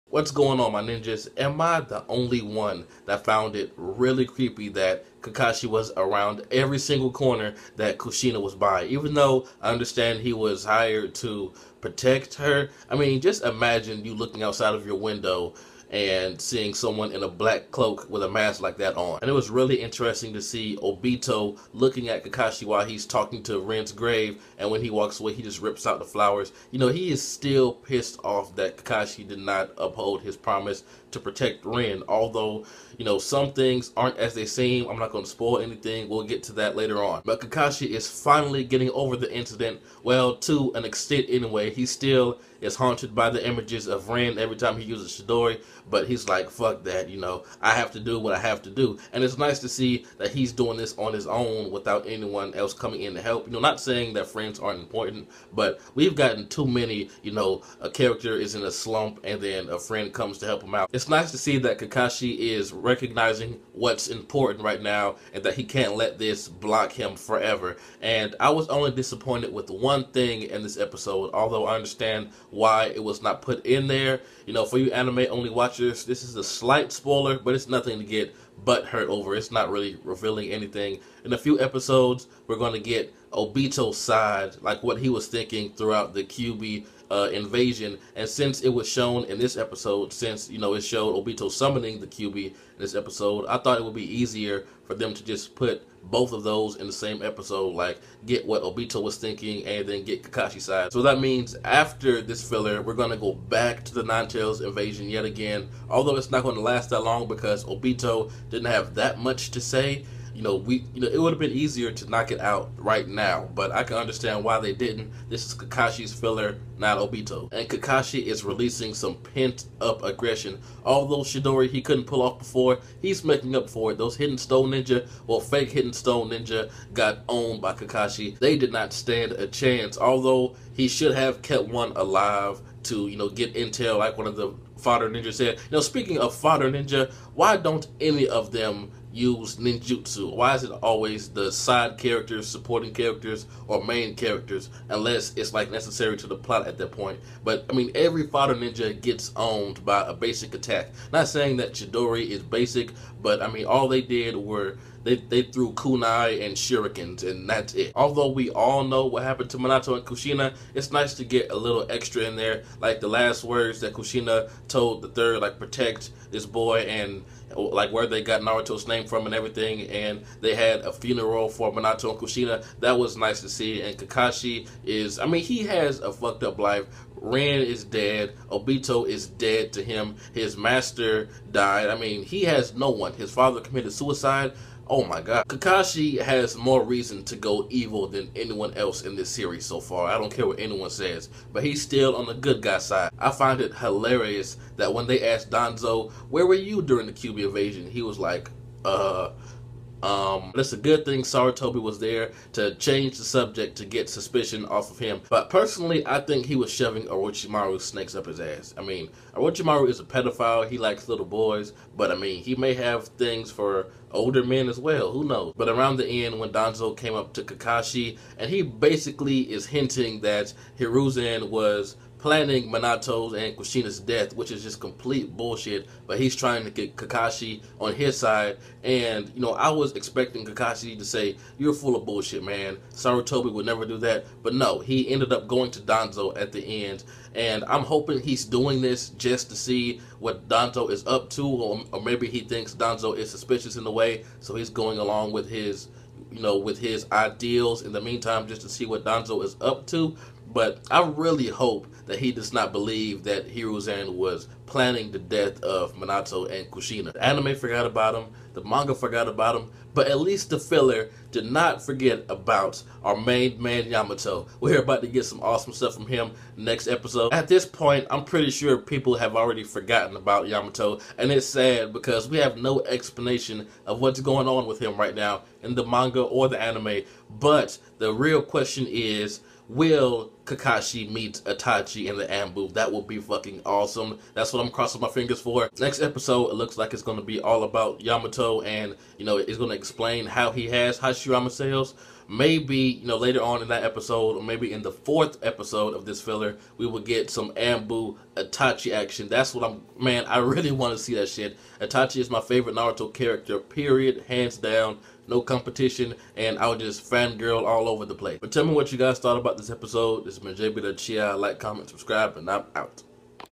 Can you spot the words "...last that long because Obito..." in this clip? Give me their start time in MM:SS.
01:46.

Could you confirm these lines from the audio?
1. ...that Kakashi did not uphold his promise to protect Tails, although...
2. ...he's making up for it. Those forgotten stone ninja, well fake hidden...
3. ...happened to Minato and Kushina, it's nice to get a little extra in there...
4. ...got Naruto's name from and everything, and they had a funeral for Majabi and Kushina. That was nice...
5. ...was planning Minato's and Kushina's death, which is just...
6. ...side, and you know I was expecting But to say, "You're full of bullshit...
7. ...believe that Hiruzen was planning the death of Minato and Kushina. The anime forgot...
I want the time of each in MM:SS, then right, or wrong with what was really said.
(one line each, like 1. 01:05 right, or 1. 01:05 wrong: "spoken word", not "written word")
1. 00:28 wrong: "Rin", not "Tails"
2. 02:03 wrong: "hidden", not "forgotten"
3. 02:39 right
4. 02:48 wrong: "Minato", not "Majabi"
5. 03:41 right
6. 03:48 wrong: "Kakashi", not "But"
7. 04:12 right.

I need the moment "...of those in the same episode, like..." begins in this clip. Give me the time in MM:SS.
01:36.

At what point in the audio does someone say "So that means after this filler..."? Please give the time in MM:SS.
01:40.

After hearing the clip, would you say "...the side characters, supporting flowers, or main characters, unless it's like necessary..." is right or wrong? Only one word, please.
wrong.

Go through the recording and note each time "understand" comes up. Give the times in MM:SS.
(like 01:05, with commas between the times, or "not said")
00:09, 01:11, 01:53.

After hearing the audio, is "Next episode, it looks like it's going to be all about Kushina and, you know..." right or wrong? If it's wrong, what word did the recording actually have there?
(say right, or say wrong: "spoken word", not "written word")
wrong: "Yamato", not "Kushina".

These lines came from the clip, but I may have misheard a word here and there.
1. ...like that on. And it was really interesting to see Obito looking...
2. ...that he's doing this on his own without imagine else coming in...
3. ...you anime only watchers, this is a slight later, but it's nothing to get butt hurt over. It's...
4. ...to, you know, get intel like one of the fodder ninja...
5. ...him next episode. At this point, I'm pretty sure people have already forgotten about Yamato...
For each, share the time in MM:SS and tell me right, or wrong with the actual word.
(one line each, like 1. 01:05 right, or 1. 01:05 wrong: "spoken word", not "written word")
1. 00:18 right
2. 00:50 wrong: "anyone", not "imagine"
3. 01:14 wrong: "spoiler", not "later"
4. 02:12 right
5. 04:26 right.